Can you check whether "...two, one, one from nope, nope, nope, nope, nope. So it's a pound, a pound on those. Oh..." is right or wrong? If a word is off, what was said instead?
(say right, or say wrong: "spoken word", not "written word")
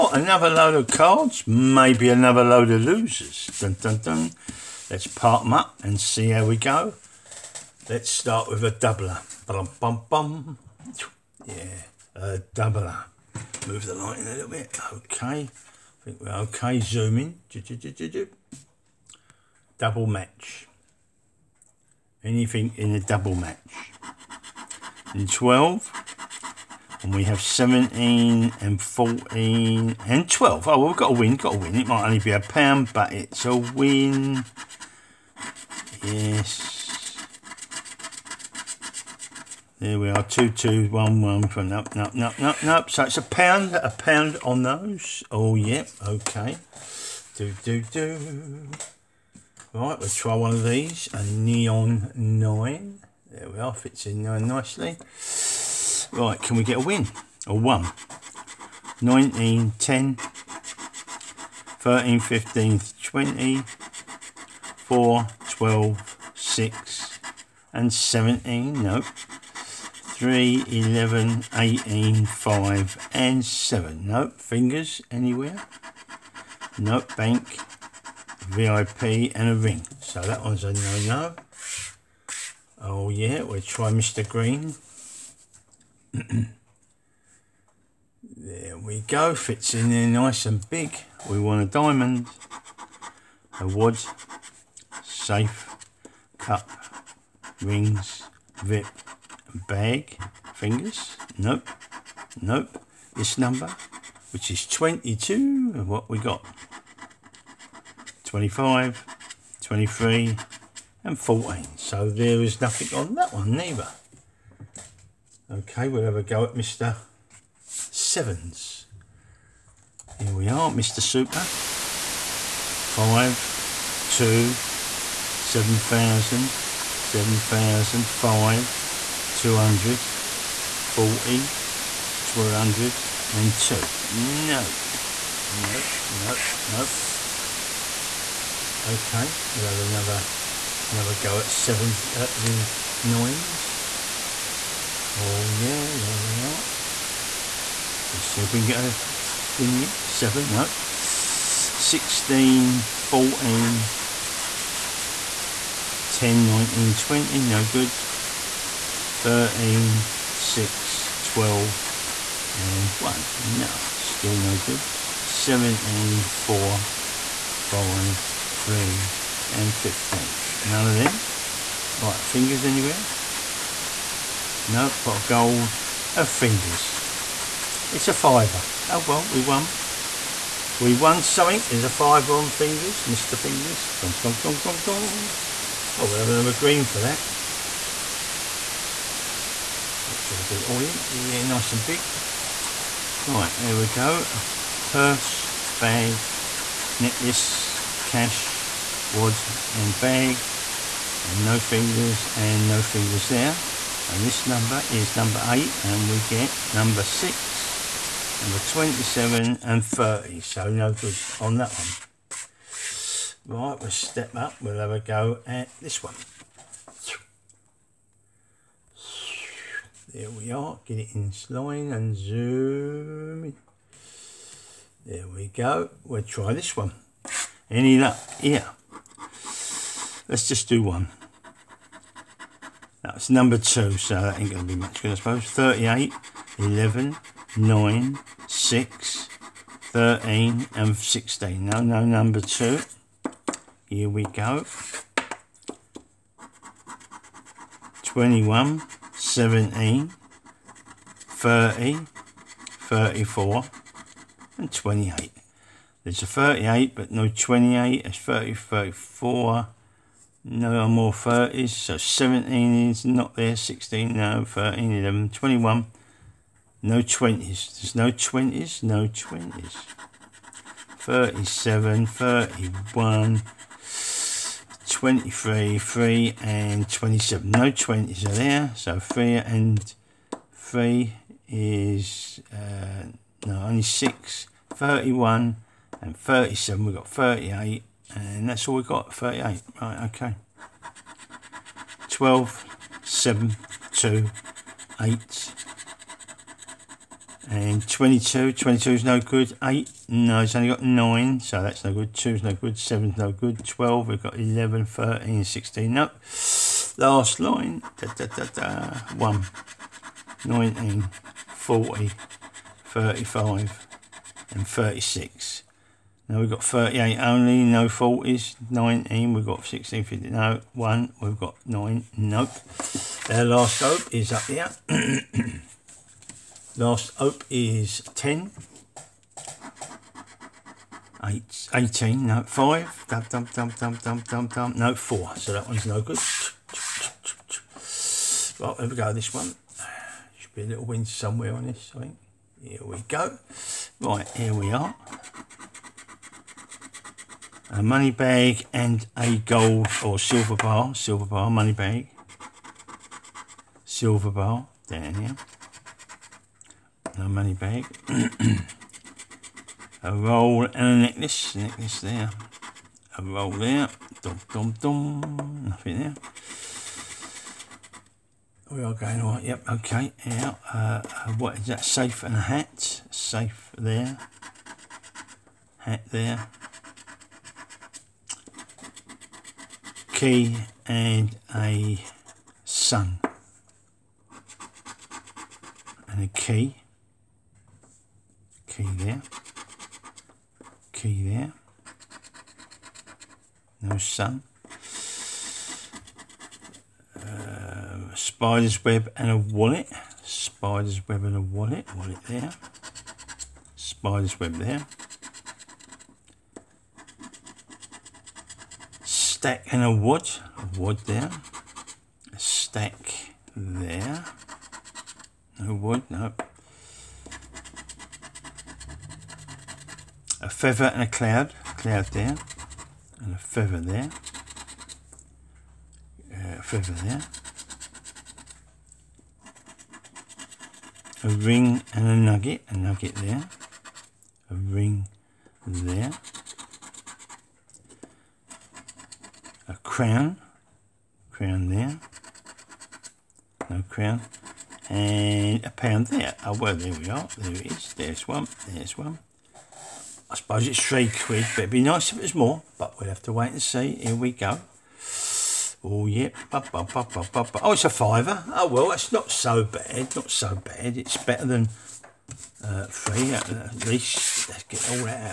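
right.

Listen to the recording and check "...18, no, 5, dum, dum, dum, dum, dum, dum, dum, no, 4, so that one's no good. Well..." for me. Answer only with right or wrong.
right.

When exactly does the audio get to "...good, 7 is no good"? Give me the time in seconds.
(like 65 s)
302 s.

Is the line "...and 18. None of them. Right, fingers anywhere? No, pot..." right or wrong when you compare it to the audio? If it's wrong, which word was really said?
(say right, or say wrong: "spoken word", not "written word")
wrong: "15", not "18".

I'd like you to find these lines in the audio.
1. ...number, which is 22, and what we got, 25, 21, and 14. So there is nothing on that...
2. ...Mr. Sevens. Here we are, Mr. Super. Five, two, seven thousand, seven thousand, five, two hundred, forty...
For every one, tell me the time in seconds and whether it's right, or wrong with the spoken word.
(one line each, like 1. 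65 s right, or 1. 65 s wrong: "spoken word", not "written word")
1. 103 s wrong: "23", not "21"
2. 116 s right.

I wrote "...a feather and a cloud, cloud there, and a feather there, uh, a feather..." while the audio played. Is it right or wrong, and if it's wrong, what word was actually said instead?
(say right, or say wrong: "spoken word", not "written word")
right.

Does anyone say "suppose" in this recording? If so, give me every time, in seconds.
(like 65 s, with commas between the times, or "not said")
235 s, 450 s.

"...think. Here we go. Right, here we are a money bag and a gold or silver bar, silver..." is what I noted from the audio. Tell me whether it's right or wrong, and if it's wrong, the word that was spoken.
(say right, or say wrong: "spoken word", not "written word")
right.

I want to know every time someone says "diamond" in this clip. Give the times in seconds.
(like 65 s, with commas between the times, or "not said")
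91 s.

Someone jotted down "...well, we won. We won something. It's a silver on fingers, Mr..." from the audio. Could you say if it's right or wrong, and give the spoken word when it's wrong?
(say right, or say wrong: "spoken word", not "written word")
wrong: "fiver", not "silver".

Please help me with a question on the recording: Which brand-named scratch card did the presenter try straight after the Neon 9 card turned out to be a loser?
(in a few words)
Mr. Green.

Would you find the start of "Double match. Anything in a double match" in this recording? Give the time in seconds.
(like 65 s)
19 s.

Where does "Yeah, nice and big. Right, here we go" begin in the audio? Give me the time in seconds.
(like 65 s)
191 s.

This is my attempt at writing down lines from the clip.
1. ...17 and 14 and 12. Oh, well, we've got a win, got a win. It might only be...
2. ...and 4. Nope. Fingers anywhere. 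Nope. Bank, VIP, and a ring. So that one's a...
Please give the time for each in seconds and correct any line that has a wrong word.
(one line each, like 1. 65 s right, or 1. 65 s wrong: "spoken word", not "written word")
1. 27 s right
2. 73 s wrong: "7", not "4".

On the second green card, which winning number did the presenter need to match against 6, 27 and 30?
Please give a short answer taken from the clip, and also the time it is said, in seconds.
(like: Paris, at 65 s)
8, at 205 s.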